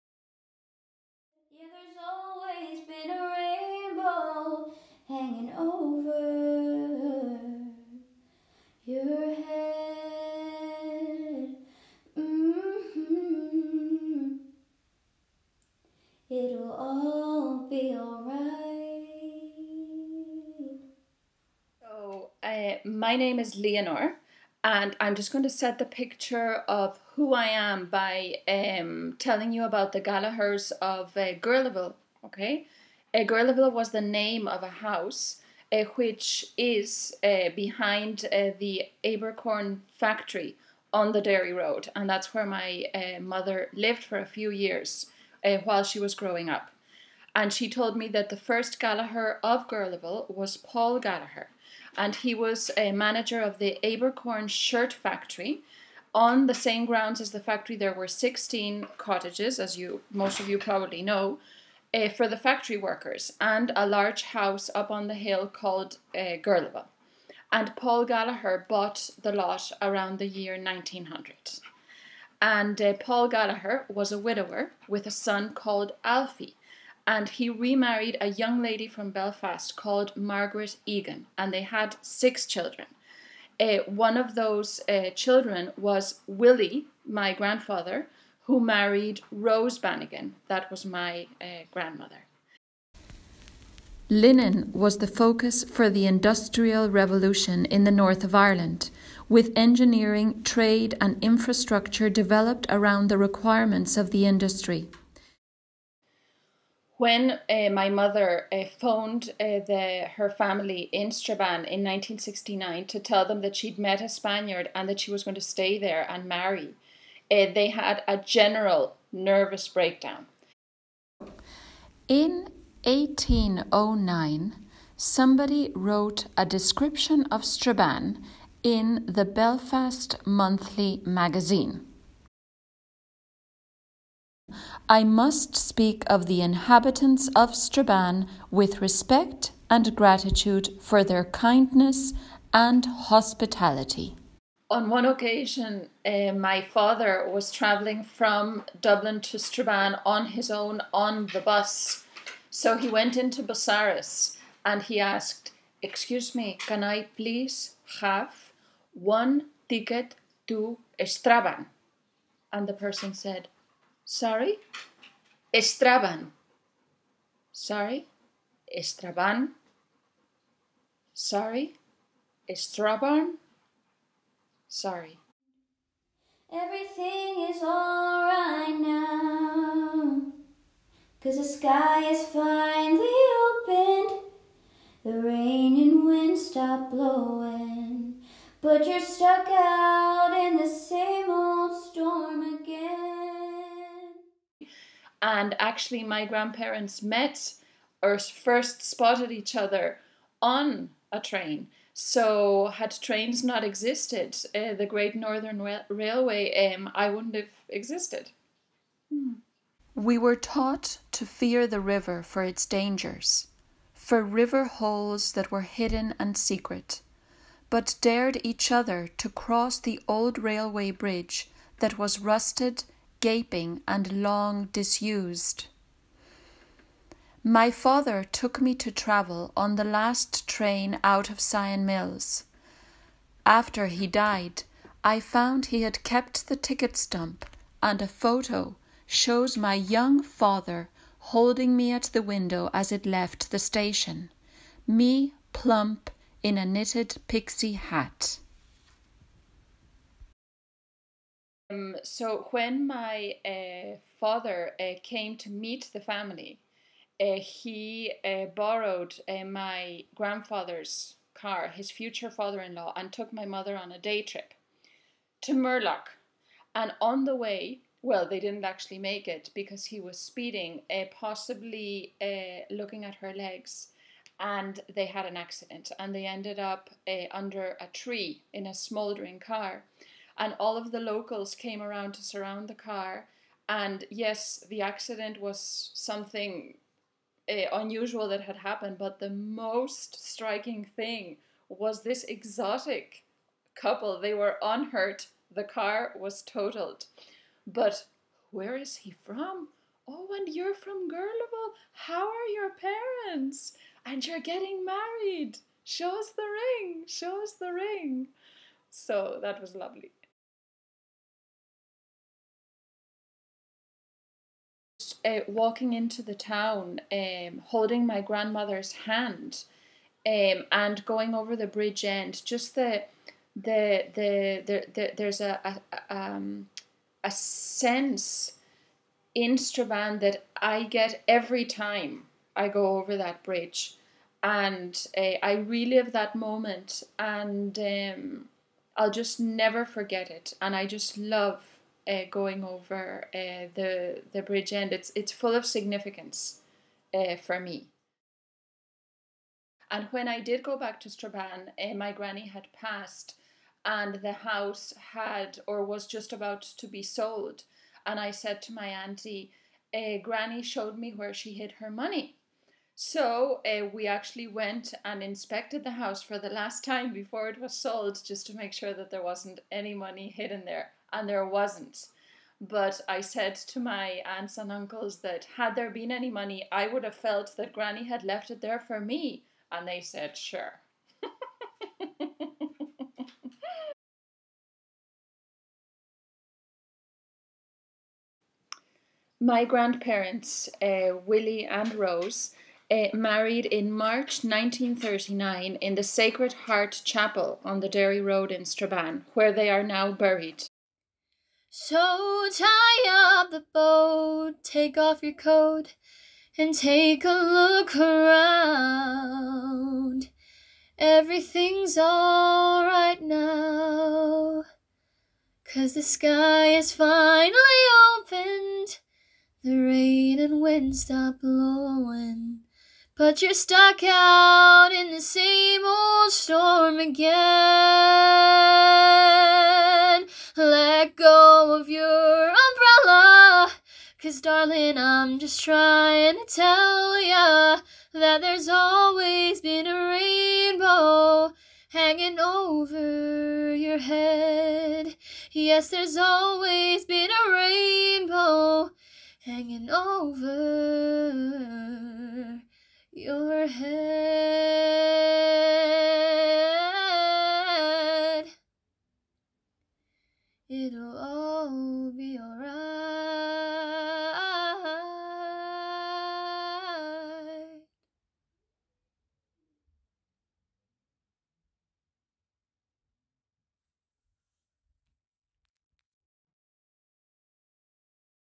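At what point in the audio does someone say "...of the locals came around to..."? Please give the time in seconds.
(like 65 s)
280 s.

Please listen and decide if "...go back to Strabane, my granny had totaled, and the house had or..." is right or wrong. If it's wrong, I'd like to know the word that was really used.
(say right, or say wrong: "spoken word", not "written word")
wrong: "passed", not "totaled".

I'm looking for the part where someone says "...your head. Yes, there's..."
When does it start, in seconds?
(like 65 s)
443 s.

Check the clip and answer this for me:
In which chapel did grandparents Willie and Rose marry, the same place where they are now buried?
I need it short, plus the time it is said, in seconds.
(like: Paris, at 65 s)
Sacred Heart Chapel, at 396 s.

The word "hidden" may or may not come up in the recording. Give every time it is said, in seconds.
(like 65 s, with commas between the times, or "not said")
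215 s, 370 s.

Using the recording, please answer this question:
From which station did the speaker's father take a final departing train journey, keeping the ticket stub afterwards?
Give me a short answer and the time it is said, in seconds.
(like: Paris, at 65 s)
Sion Mills, at 231 s.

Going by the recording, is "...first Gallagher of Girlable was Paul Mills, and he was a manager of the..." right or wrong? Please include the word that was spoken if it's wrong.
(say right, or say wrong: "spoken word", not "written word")
wrong: "Gallagher", not "Mills".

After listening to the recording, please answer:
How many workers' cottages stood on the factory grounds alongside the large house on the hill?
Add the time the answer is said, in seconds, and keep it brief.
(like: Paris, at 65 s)
16, at 58 s.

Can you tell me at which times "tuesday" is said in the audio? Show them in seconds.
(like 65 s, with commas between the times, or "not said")
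not said.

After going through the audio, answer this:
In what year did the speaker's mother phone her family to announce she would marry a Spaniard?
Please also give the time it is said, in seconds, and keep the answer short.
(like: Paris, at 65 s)
1969, at 111 s.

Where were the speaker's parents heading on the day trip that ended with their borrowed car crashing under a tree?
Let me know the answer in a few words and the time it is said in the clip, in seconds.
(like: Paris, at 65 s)
Moorlough, at 265 s.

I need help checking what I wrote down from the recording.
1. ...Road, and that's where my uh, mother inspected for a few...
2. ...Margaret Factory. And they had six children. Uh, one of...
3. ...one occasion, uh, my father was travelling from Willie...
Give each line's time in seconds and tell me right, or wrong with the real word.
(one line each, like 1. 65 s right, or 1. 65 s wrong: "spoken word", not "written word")
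1. 41 s wrong: "lived", not "inspected"
2. 80 s wrong: "Egan", not "Factory"
3. 144 s wrong: "Dublin", not "Willie".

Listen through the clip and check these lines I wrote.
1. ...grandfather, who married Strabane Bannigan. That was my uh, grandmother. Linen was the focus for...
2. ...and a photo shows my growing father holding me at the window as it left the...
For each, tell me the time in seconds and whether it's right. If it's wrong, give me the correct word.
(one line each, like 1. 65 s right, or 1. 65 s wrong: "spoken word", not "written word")
1. 87 s wrong: "Rose", not "Strabane"
2. 237 s wrong: "young", not "growing".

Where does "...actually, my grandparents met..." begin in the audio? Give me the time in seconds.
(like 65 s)
195 s.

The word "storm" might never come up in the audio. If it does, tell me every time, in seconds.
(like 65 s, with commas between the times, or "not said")
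191 s, 426 s.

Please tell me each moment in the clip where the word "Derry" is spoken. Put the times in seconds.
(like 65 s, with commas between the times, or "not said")
41 s, 397 s.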